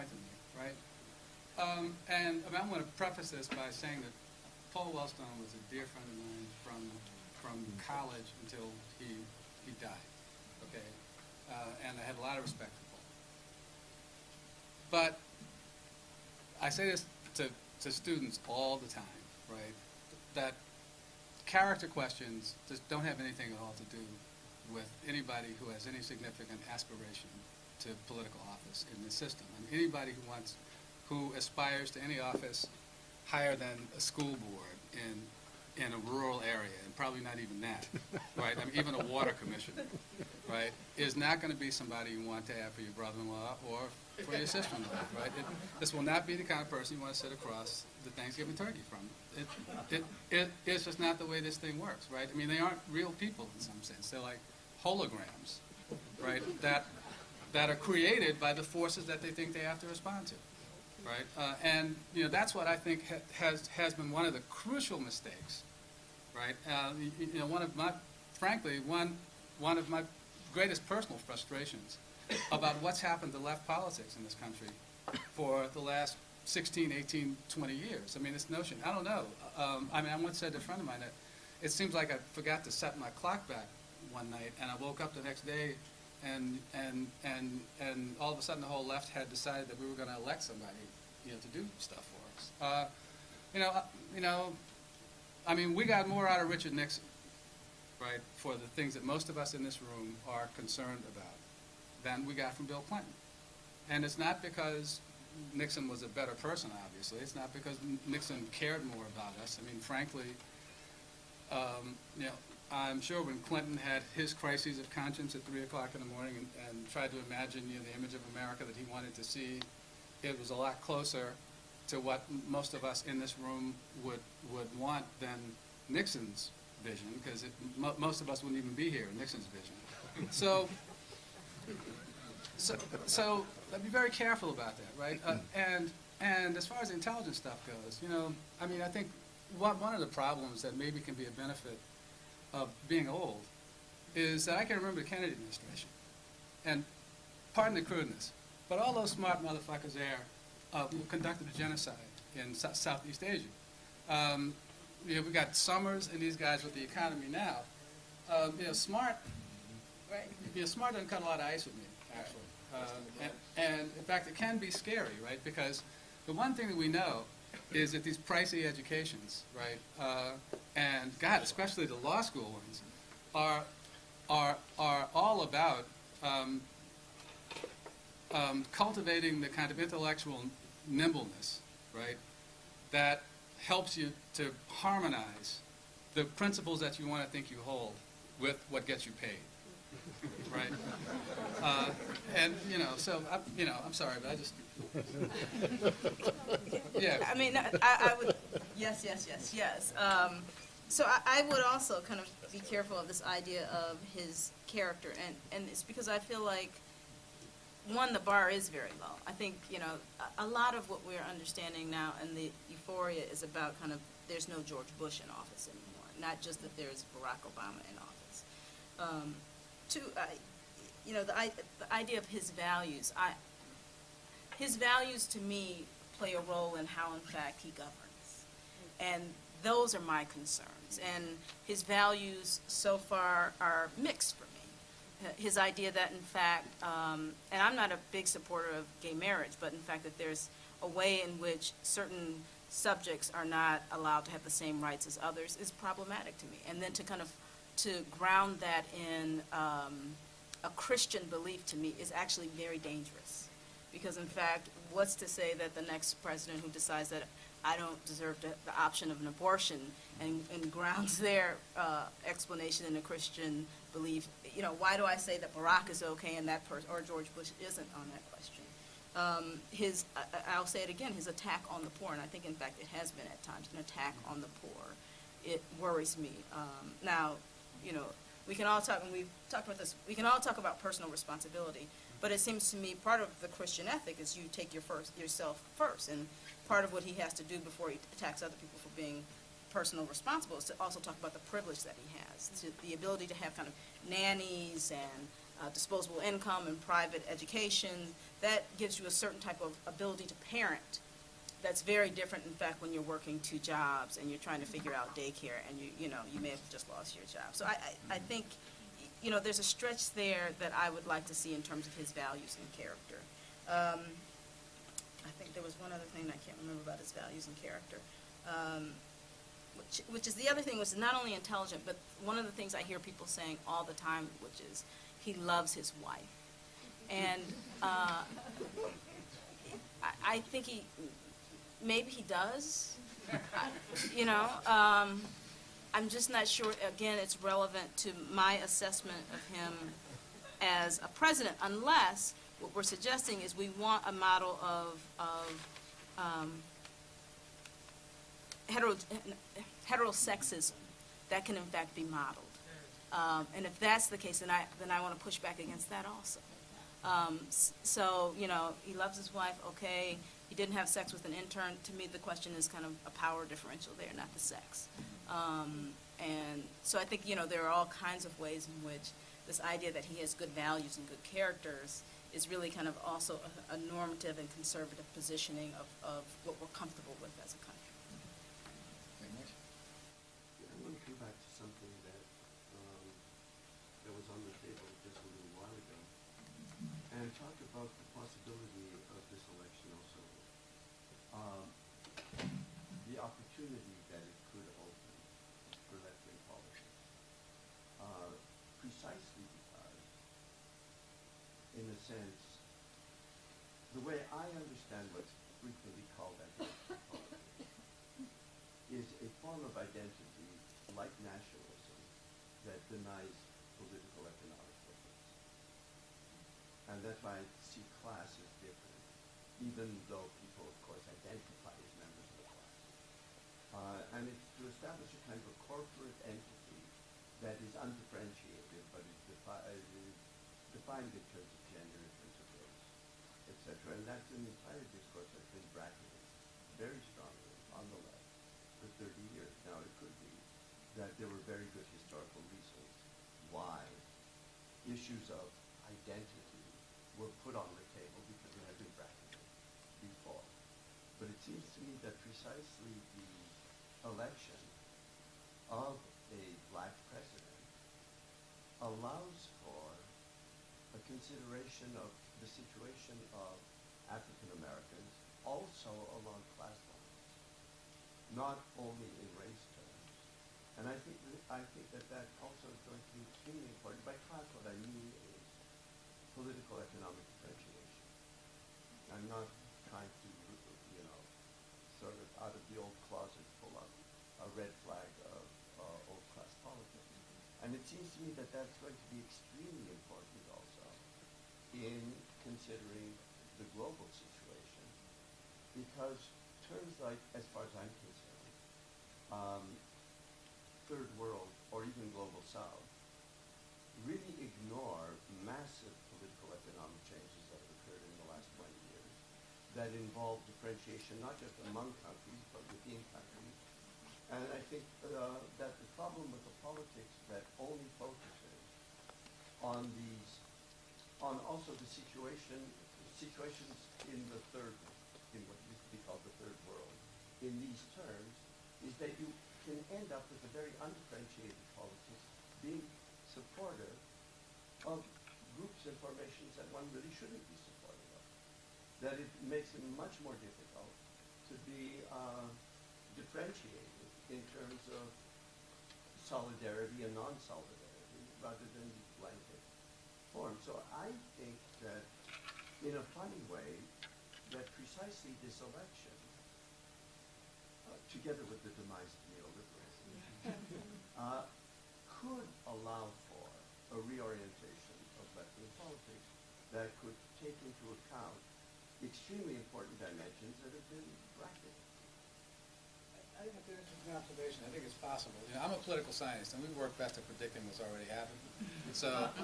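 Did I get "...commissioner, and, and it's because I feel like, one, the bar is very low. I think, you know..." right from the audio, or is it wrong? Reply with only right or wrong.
wrong.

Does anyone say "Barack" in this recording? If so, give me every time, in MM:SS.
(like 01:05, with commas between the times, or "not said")
03:37, 04:25.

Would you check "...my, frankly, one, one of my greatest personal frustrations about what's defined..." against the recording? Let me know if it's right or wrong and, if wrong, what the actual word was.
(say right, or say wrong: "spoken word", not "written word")
wrong: "happened", not "defined".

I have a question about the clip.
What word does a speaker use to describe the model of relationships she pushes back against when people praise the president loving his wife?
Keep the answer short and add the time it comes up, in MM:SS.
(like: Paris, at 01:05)
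heterosexism, at 05:49.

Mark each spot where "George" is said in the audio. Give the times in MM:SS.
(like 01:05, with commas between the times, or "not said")
03:34, 04:27.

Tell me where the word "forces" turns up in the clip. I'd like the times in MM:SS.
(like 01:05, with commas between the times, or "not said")
00:58.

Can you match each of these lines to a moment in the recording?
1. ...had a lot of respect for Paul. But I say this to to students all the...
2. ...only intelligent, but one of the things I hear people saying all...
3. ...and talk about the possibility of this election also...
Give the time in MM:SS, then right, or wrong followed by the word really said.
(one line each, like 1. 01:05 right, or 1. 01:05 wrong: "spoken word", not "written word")
1. 00:12 right
2. 05:21 right
3. 06:27 right.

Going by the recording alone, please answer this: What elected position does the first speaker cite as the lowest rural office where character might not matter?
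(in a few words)
school board.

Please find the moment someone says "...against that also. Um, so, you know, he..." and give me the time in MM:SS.
05:55.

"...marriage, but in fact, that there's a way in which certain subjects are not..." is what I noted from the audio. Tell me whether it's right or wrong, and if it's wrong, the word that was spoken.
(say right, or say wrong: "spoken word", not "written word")
right.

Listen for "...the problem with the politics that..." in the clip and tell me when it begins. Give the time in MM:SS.
08:35.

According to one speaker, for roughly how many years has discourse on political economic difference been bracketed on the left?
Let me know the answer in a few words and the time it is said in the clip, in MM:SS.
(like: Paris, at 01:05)
30 years, at 07:19.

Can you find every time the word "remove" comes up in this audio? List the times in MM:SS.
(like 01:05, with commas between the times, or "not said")
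not said.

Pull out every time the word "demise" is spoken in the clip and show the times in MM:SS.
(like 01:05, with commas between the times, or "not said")
09:18.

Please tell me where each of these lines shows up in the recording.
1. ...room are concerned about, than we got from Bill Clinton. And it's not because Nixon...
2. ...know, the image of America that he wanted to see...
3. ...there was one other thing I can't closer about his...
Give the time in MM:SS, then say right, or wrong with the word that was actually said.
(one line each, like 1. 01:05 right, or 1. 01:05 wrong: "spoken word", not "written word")
1. 01:39 right
2. 01:57 right
3. 05:15 wrong: "remember", not "closer".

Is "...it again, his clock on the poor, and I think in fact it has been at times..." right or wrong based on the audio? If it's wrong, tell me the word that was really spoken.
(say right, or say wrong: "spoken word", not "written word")
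wrong: "attack", not "clock".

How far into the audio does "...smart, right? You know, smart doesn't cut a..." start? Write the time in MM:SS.
02:38.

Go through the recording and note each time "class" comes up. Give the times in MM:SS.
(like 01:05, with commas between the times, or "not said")
06:58, 07:02, 07:46, 07:54.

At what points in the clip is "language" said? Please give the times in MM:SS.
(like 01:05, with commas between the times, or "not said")
not said.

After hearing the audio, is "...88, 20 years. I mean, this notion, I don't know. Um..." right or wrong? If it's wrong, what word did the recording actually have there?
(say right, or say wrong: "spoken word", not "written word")
wrong: "18", not "88".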